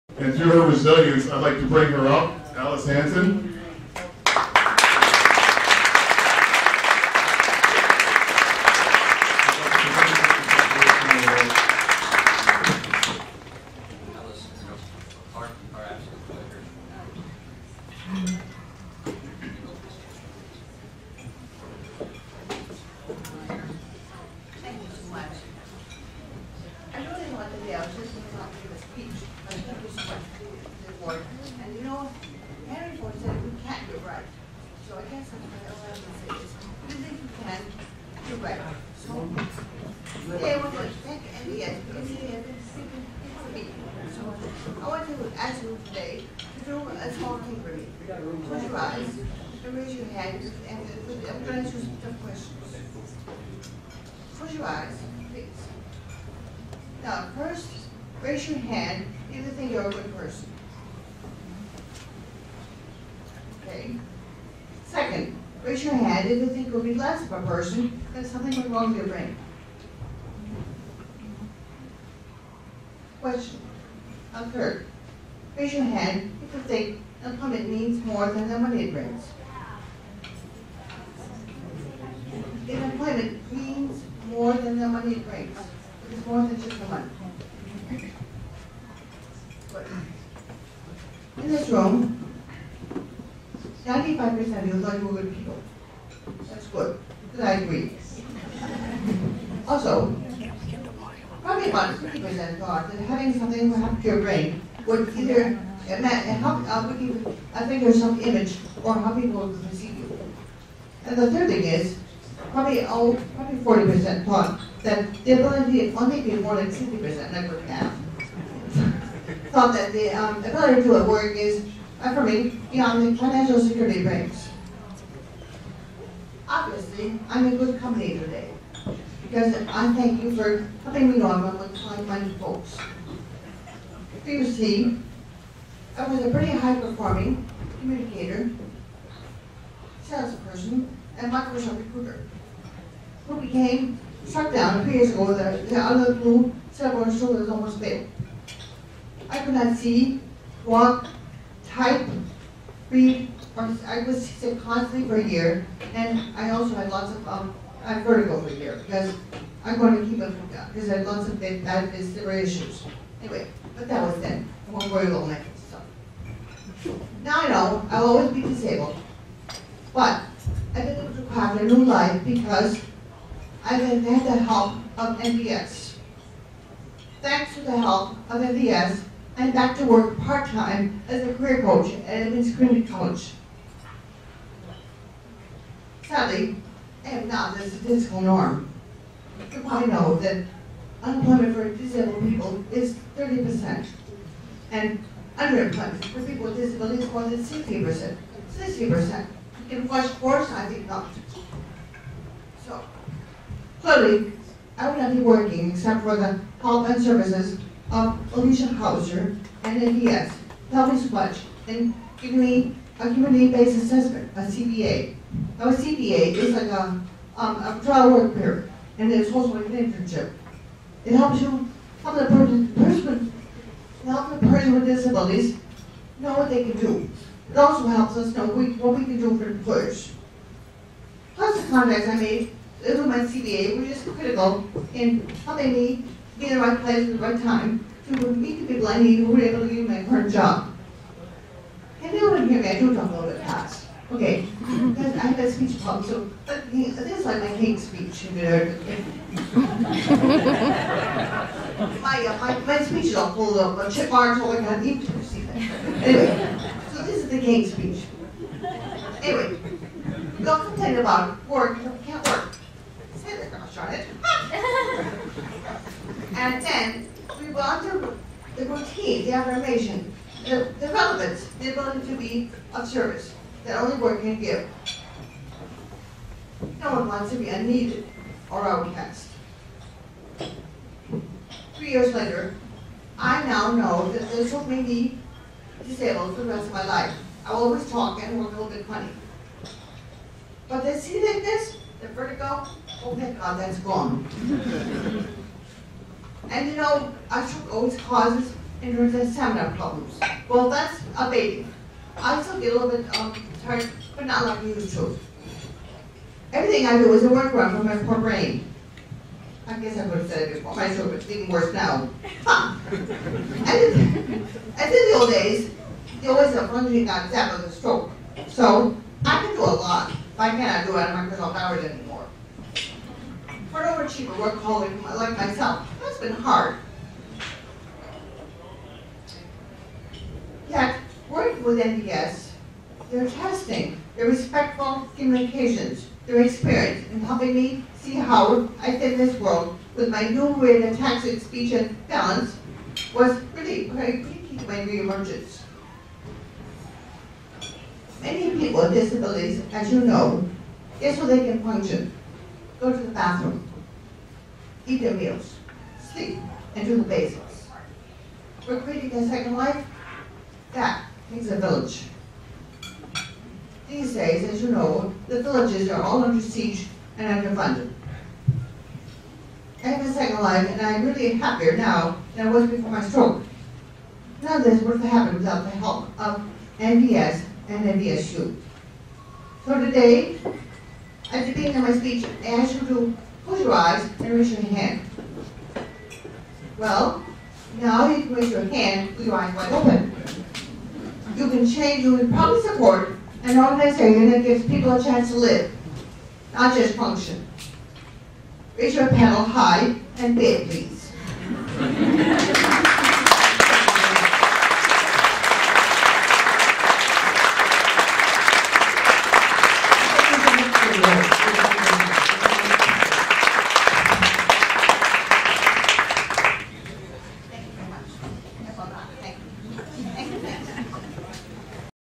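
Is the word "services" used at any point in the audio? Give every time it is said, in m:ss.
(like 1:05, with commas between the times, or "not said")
3:27, 4:32.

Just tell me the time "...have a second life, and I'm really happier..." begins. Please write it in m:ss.
6:09.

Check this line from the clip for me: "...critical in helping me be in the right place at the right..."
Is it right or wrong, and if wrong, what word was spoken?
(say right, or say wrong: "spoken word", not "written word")
right.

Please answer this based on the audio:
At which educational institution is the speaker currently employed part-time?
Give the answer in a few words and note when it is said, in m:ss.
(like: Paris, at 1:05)
Edmonds Community College, at 3:02.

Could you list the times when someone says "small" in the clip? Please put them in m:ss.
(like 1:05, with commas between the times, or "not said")
0:47.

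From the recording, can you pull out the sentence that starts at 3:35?
Now a CBA is like a, um, a trial work period, and it's also like an internship.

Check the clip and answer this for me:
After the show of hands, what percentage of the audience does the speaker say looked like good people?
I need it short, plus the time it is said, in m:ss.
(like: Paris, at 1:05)
95%, at 1:33.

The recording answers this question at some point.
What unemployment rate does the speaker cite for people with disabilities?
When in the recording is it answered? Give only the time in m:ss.
3:13.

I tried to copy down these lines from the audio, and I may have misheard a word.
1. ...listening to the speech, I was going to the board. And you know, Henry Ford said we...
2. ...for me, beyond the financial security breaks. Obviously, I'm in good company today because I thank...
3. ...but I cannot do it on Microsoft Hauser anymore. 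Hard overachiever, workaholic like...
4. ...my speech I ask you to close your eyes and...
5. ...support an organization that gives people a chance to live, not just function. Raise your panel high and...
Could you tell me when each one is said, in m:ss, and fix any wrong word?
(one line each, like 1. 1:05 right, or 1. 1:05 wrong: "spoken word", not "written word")
1. 0:27 right
2. 2:02 right
3. 5:20 wrong: "Hours", not "Hauser"
4. 6:21 right
5. 6:32 right.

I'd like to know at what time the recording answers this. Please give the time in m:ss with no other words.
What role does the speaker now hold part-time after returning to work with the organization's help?
3:01.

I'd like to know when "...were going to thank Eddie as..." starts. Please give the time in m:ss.
0:40.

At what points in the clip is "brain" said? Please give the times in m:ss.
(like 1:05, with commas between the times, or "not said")
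1:09, 1:44, 5:08.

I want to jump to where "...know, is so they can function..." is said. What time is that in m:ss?
5:50.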